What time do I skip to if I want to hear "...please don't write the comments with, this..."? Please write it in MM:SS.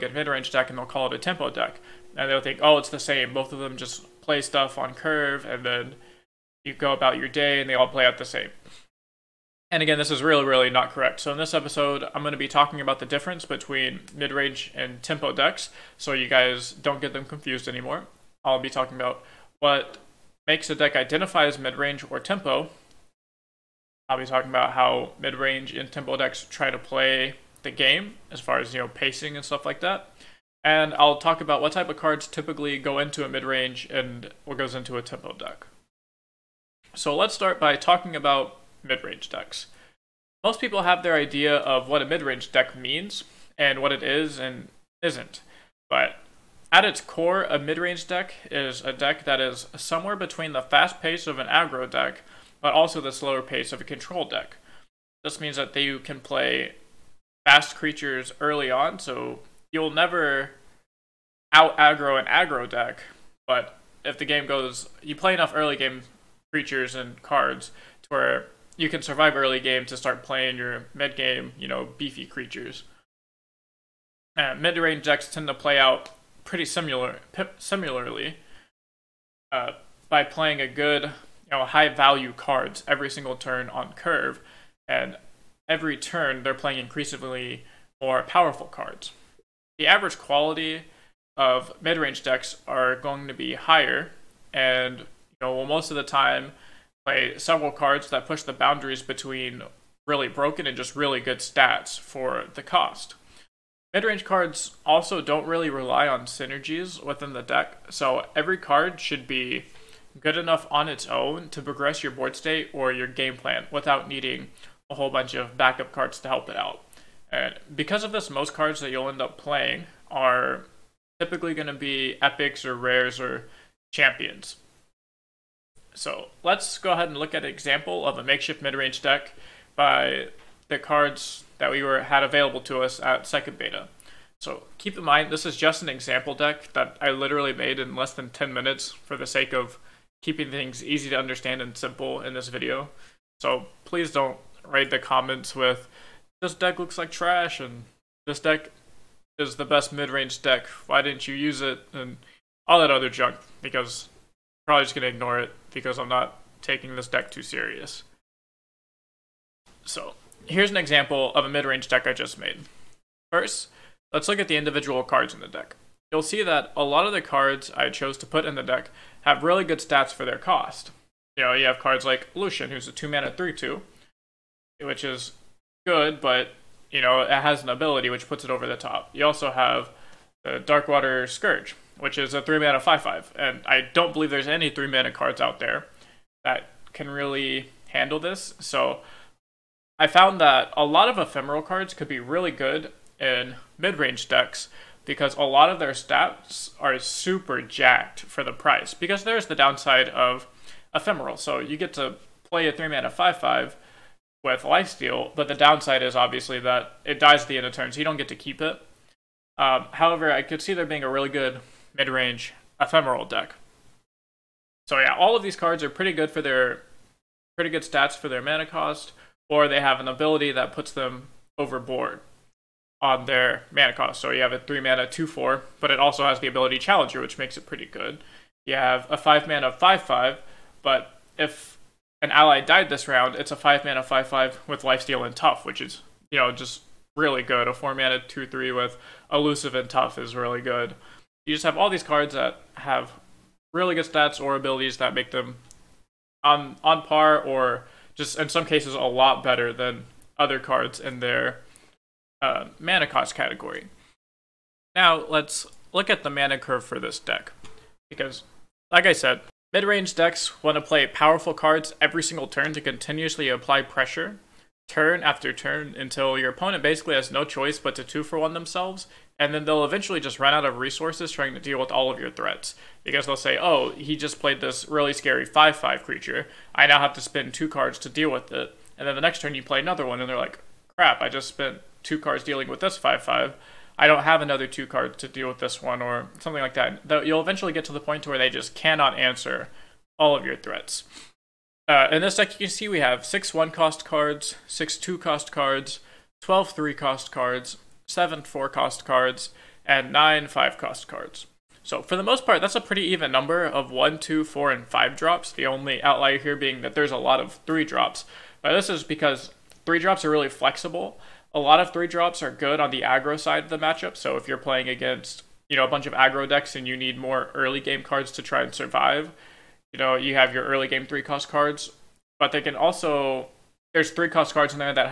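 02:23.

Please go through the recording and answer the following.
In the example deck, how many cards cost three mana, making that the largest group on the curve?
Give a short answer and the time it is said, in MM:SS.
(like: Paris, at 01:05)
12, at 04:56.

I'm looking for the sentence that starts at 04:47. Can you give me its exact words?
Though you'll eventually get to the point where they just cannot answer all of your threats.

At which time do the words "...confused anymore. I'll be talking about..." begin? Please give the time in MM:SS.
00:17.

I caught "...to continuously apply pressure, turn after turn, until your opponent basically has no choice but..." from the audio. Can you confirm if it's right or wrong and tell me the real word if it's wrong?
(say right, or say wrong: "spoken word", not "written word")
right.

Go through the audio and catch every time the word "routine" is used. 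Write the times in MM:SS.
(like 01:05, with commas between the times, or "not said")
not said.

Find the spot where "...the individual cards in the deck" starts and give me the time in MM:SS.
02:44.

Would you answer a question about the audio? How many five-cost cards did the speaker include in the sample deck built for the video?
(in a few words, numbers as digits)
9.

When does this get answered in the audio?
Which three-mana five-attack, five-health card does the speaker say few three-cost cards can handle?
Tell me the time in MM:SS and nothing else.
03:00.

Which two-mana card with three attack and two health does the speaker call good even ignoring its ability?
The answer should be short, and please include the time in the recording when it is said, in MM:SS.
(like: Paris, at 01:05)
Lucian, at 02:52.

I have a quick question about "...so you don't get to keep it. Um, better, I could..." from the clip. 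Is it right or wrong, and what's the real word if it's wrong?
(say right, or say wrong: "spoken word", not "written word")
wrong: "however", not "better".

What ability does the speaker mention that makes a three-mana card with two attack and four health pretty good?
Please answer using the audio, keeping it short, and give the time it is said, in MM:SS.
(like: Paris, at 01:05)
Challenger, at 03:46.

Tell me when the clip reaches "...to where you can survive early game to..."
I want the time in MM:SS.
01:08.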